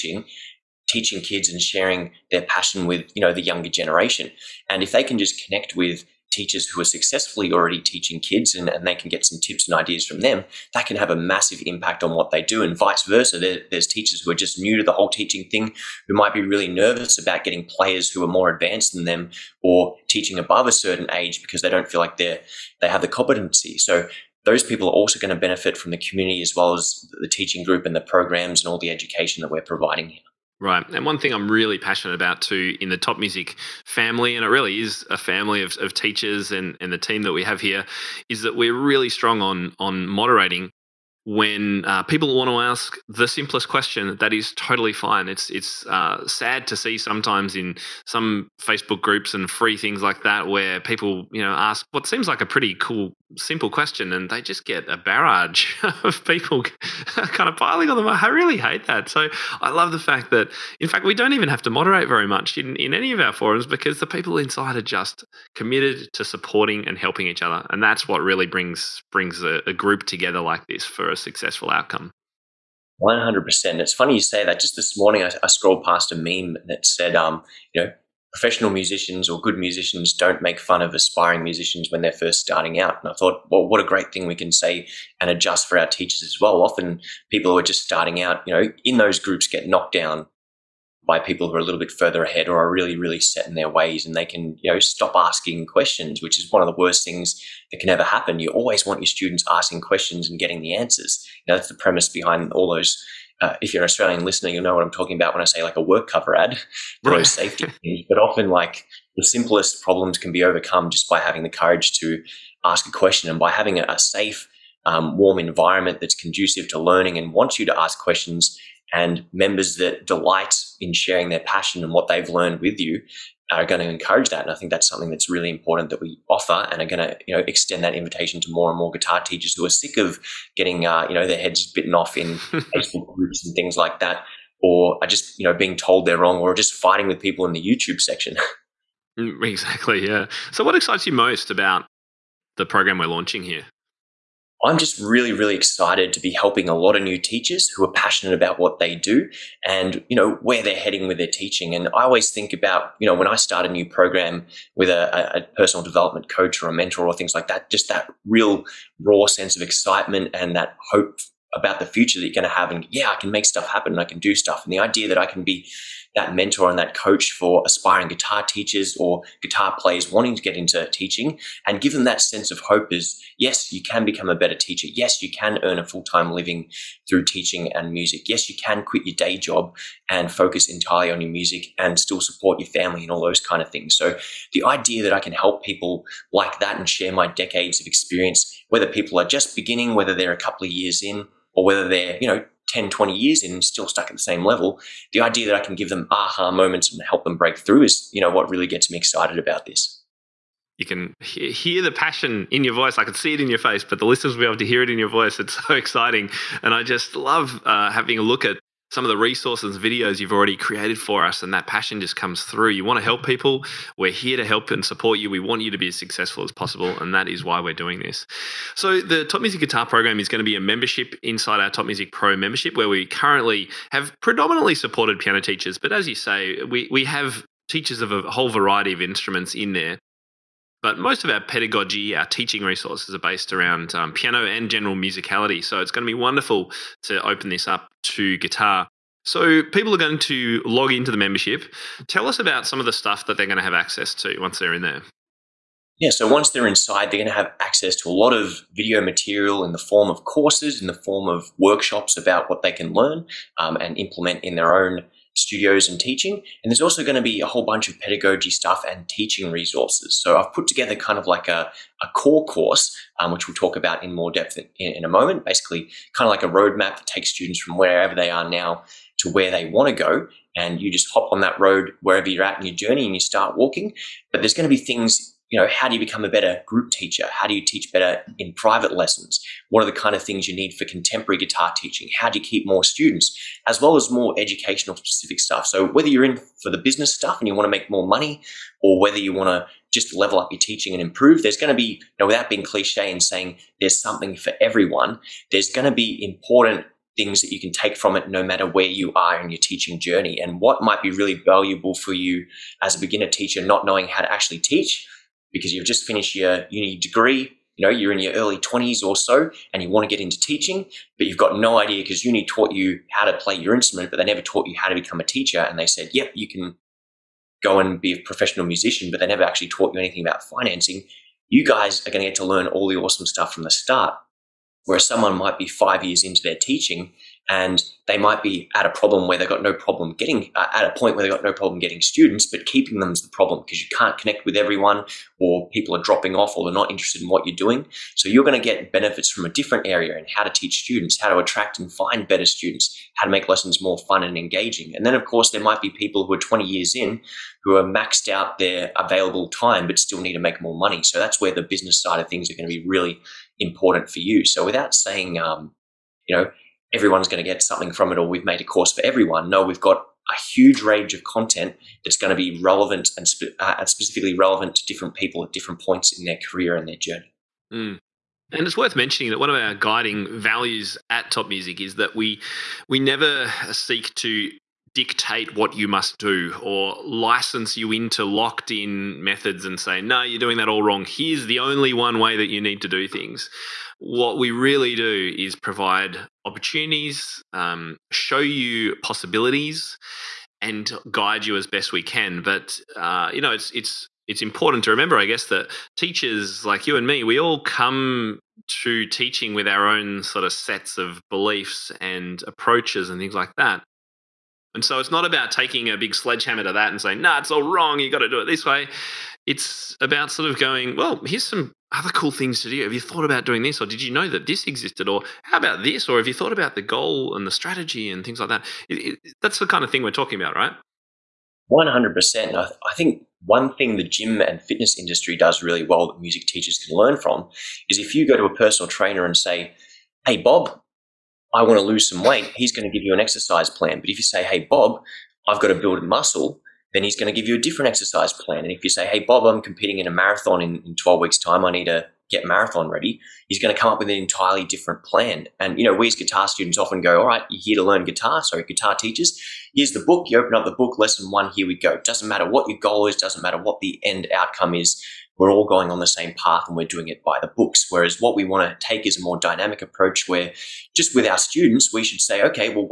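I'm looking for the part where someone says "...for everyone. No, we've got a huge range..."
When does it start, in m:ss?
5:58.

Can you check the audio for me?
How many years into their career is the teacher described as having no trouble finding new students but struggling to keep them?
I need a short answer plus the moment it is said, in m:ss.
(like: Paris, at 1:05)
5, at 5:25.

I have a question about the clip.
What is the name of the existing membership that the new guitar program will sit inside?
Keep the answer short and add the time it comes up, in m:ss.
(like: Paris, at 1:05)
Top Music Pro, at 3:41.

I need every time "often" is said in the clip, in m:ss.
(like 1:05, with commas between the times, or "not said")
1:26, 1:48, 7:26.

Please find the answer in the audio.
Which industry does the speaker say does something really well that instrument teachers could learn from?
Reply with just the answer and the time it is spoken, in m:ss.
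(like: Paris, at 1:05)
Gym and fitness industry, at 7:04.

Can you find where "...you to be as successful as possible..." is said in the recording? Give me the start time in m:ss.
3:35.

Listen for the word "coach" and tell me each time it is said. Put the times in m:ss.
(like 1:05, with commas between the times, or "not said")
2:36, 2:46.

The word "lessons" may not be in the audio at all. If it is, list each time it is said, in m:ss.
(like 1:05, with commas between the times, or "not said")
4:38, 5:43, 7:30.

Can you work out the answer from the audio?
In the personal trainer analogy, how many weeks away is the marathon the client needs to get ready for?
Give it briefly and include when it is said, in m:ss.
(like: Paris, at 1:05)
12 weeks, at 7:20.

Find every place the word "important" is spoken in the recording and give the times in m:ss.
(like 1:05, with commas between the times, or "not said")
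2:05, 4:56, 5:53, 6:34.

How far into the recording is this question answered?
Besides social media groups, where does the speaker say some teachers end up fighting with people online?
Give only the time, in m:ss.
2:17.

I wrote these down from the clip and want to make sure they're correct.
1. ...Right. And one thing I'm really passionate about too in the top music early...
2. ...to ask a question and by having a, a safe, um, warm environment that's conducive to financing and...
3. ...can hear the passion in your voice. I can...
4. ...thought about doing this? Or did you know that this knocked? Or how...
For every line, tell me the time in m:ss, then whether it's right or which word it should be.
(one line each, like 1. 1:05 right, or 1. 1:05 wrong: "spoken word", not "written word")
1. 0:30 wrong: "family", not "early"
2. 1:51 wrong: "learning", not "financing"
3. 3:20 right
4. 6:53 wrong: "existed", not "knocked".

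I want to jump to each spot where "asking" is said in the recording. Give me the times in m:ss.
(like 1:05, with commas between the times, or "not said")
1:35, 1:39.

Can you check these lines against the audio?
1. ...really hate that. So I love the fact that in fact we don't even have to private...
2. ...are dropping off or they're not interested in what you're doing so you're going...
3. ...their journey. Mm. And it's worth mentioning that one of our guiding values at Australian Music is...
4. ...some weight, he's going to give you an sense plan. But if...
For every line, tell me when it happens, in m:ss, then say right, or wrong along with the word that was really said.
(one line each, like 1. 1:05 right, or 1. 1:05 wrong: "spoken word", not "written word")
1. 0:58 wrong: "moderate", not "private"
2. 5:35 right
3. 6:06 wrong: "Top", not "Australian"
4. 7:12 wrong: "exercise", not "sense".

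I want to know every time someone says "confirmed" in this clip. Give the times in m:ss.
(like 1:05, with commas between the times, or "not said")
not said.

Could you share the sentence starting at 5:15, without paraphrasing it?
And they said, yep, you can go and be a professional musician, but they never actually taught you anything about financing.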